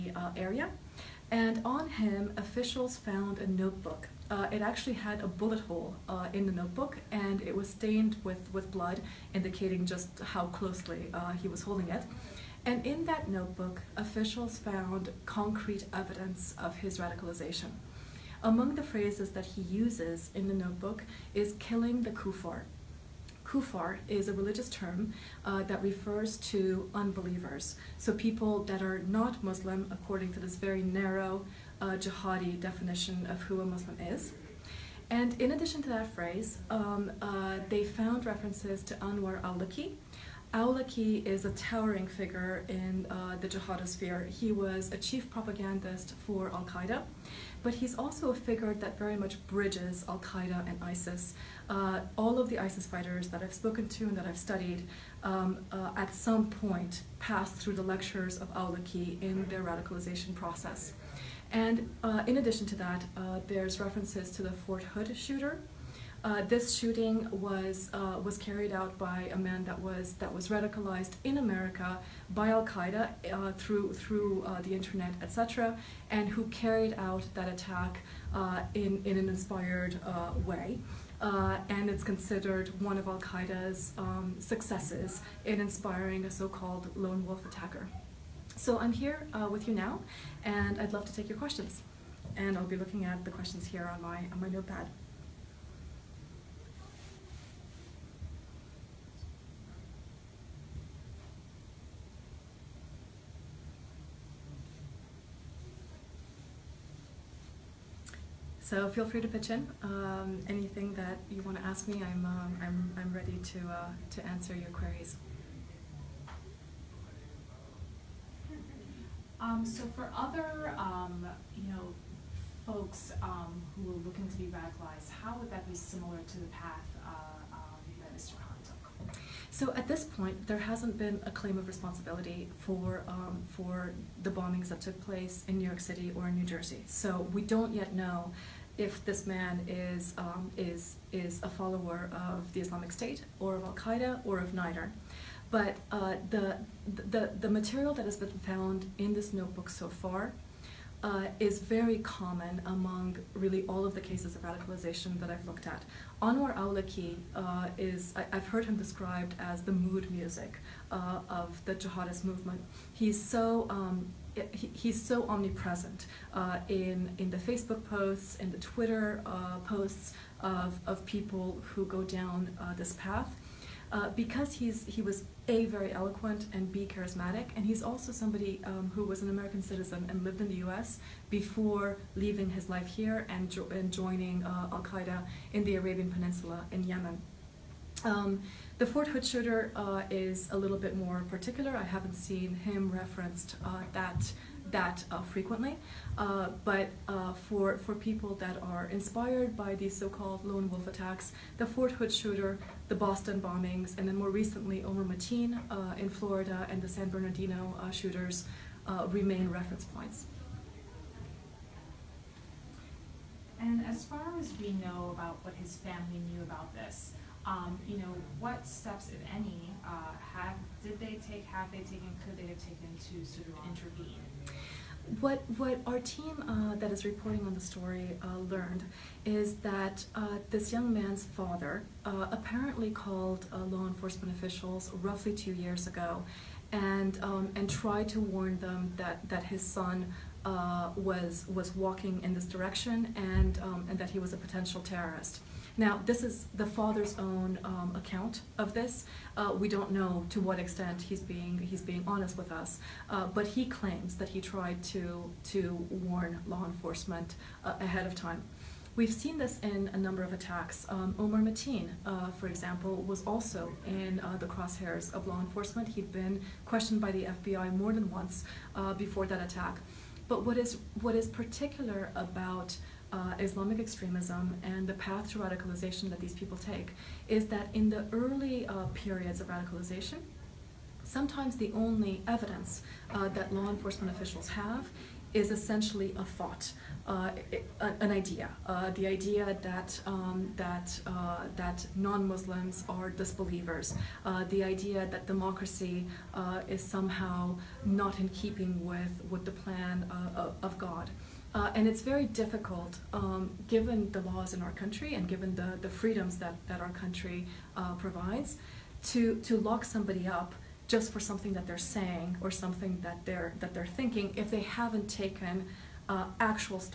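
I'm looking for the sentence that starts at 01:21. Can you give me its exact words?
and it's considered one of Al Qaeda's um, successes in inspiring a so-called lone wolf attacker.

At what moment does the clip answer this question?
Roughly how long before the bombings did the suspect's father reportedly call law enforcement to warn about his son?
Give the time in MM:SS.
03:55.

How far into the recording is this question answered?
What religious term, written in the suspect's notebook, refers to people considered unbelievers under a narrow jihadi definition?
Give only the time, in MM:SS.
00:23.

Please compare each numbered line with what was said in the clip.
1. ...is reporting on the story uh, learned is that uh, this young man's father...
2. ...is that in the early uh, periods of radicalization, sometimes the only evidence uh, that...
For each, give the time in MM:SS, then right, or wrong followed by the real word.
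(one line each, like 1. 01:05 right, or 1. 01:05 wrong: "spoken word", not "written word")
1. 03:46 right
2. 04:37 right.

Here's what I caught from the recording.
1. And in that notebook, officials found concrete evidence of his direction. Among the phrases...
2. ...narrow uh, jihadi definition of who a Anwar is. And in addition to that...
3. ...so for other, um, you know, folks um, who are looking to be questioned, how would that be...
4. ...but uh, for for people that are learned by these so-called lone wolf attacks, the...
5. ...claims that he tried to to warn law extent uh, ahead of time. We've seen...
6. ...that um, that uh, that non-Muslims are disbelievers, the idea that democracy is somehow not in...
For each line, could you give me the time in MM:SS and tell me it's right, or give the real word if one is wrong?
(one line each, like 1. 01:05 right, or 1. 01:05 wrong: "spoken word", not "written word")
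1. 00:12 wrong: "radicalization", not "direction"
2. 00:30 wrong: "Muslim", not "Anwar"
3. 01:59 wrong: "radicalized", not "questioned"
4. 03:16 wrong: "inspired", not "learned"
5. 04:13 wrong: "enforcement", not "extent"
6. 04:49 right.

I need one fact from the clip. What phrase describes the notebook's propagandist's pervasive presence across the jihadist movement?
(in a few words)
the mood music.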